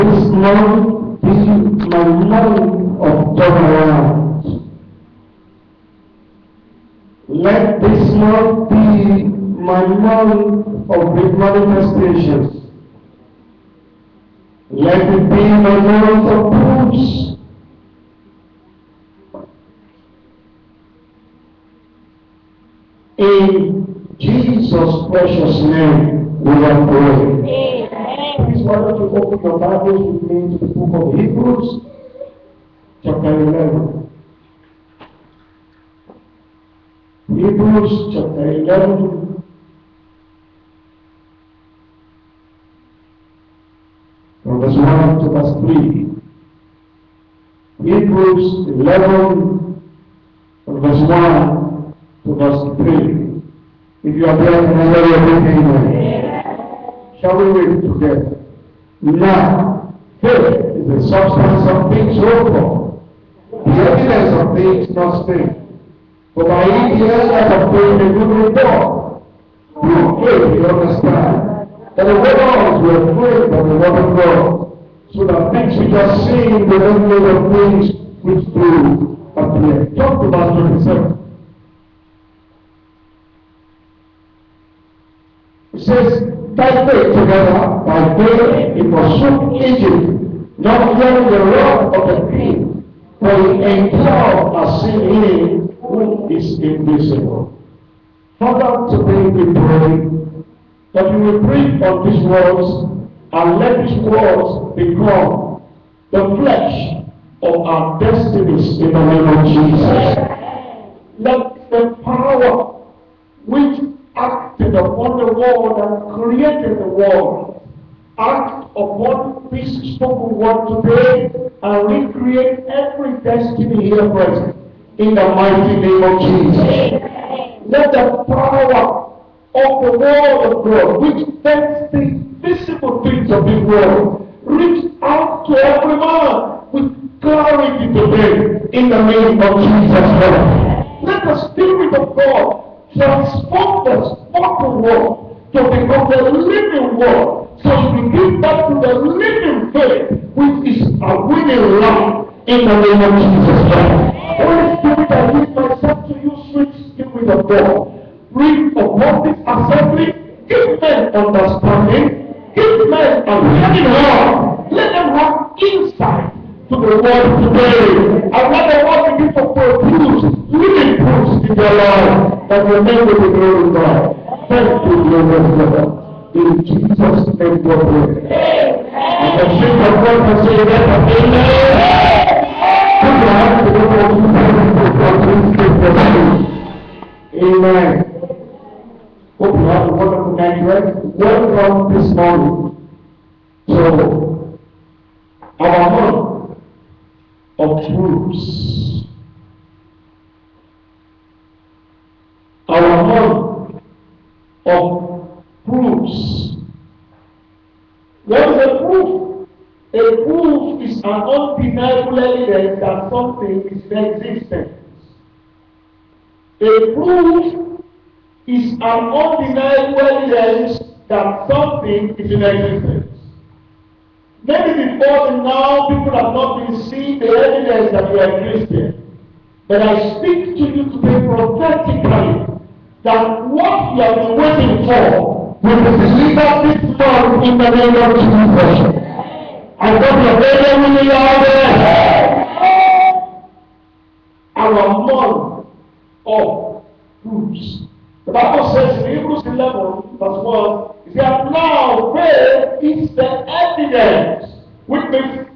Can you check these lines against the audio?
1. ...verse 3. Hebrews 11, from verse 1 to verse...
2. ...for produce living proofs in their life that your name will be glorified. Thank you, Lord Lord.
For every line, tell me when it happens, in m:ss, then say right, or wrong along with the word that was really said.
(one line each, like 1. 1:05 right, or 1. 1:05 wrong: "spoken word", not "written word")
1. 0:45 right
2. 2:49 right.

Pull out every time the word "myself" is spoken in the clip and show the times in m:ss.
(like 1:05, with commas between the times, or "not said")
2:35.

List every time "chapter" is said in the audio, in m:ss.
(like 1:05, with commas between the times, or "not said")
0:33, 0:38.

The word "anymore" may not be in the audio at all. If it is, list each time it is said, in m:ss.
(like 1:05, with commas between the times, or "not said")
not said.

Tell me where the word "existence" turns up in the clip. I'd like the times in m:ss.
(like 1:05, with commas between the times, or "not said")
3:34, 3:42.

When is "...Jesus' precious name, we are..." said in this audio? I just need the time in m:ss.
0:24.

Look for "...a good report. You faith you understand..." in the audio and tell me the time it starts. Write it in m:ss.
1:08.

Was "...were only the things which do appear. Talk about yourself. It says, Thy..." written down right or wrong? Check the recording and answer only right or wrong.
right.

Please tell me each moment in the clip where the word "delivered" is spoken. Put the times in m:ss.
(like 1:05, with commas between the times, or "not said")
3:55.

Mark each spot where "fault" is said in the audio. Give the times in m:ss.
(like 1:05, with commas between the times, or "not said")
not said.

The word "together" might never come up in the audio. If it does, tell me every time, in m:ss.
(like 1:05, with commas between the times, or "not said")
0:57, 1:27.